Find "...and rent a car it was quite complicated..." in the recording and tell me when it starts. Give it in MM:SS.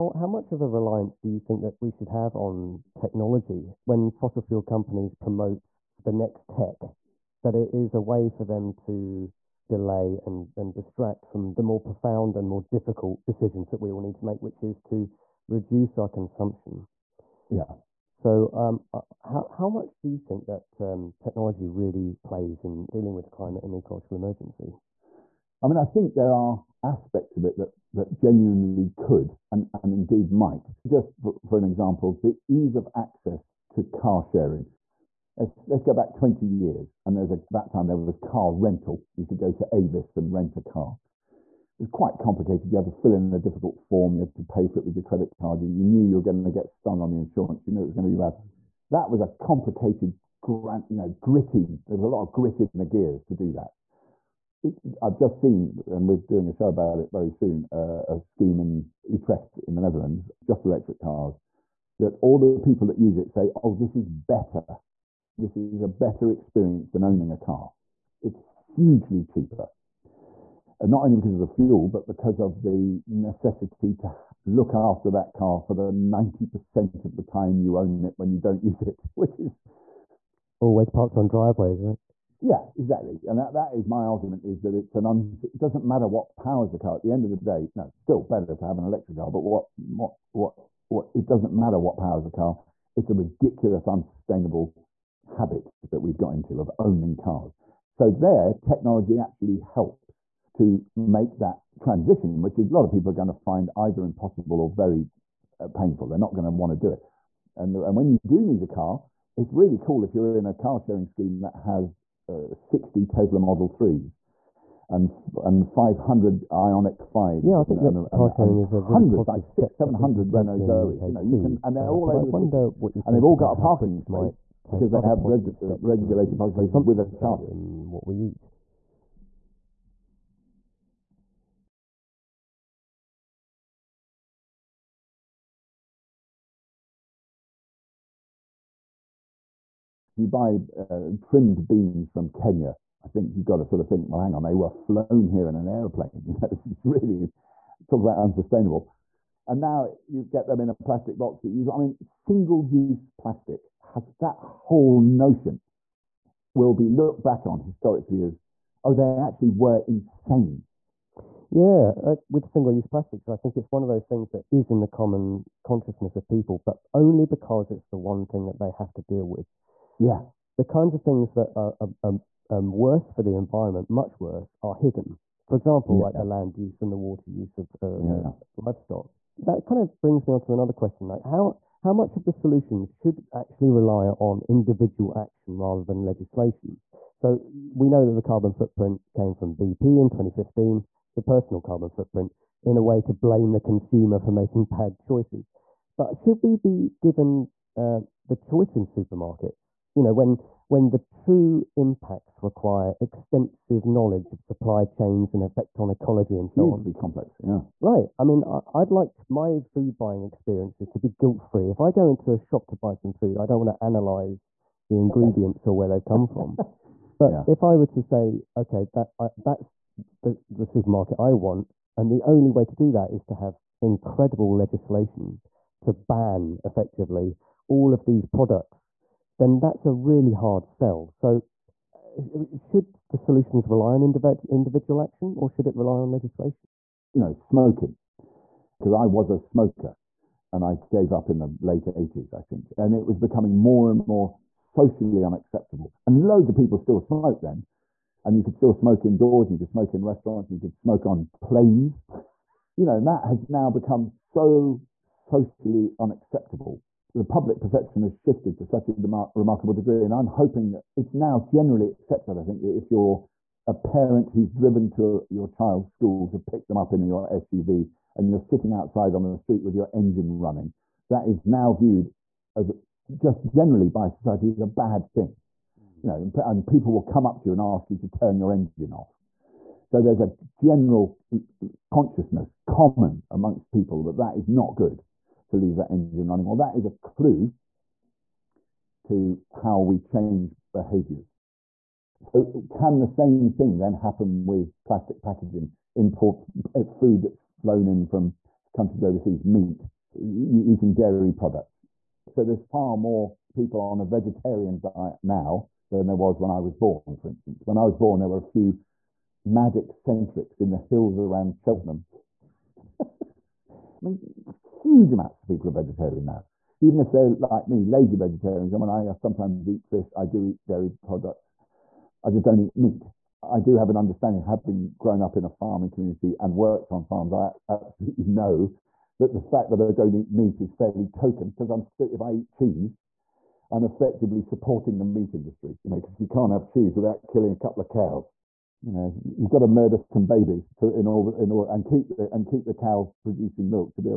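00:40.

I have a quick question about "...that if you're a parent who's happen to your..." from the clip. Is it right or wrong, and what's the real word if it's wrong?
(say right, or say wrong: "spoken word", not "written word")
wrong: "driven", not "happen".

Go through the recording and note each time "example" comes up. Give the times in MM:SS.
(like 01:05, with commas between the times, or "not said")
00:31, 02:55.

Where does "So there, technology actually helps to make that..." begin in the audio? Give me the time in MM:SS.
01:37.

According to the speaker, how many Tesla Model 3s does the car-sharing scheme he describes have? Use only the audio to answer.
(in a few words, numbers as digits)
60.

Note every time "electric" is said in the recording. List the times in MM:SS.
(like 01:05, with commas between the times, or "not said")
01:00, 01:28.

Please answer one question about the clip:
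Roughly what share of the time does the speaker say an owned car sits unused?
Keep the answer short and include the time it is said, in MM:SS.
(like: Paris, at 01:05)
90%, at 01:15.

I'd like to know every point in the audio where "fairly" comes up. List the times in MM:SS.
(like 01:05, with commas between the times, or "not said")
05:30.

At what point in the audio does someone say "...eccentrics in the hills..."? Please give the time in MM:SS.
05:09.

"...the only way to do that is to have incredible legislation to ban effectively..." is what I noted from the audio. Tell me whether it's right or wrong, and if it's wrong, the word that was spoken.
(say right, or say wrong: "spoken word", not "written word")
right.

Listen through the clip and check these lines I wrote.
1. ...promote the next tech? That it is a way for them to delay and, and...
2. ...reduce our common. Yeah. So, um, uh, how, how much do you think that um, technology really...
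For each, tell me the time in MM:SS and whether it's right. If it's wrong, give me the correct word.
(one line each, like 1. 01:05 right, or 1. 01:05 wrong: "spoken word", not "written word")
1. 00:05 right
2. 00:15 wrong: "consumption", not "common".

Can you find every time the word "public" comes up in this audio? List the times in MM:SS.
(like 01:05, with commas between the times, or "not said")
02:06, 04:17.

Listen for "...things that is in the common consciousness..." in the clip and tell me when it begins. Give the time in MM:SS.
02:44.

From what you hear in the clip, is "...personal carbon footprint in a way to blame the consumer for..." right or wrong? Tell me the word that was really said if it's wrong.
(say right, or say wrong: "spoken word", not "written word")
right.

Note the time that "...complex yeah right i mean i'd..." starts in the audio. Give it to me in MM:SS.
03:26.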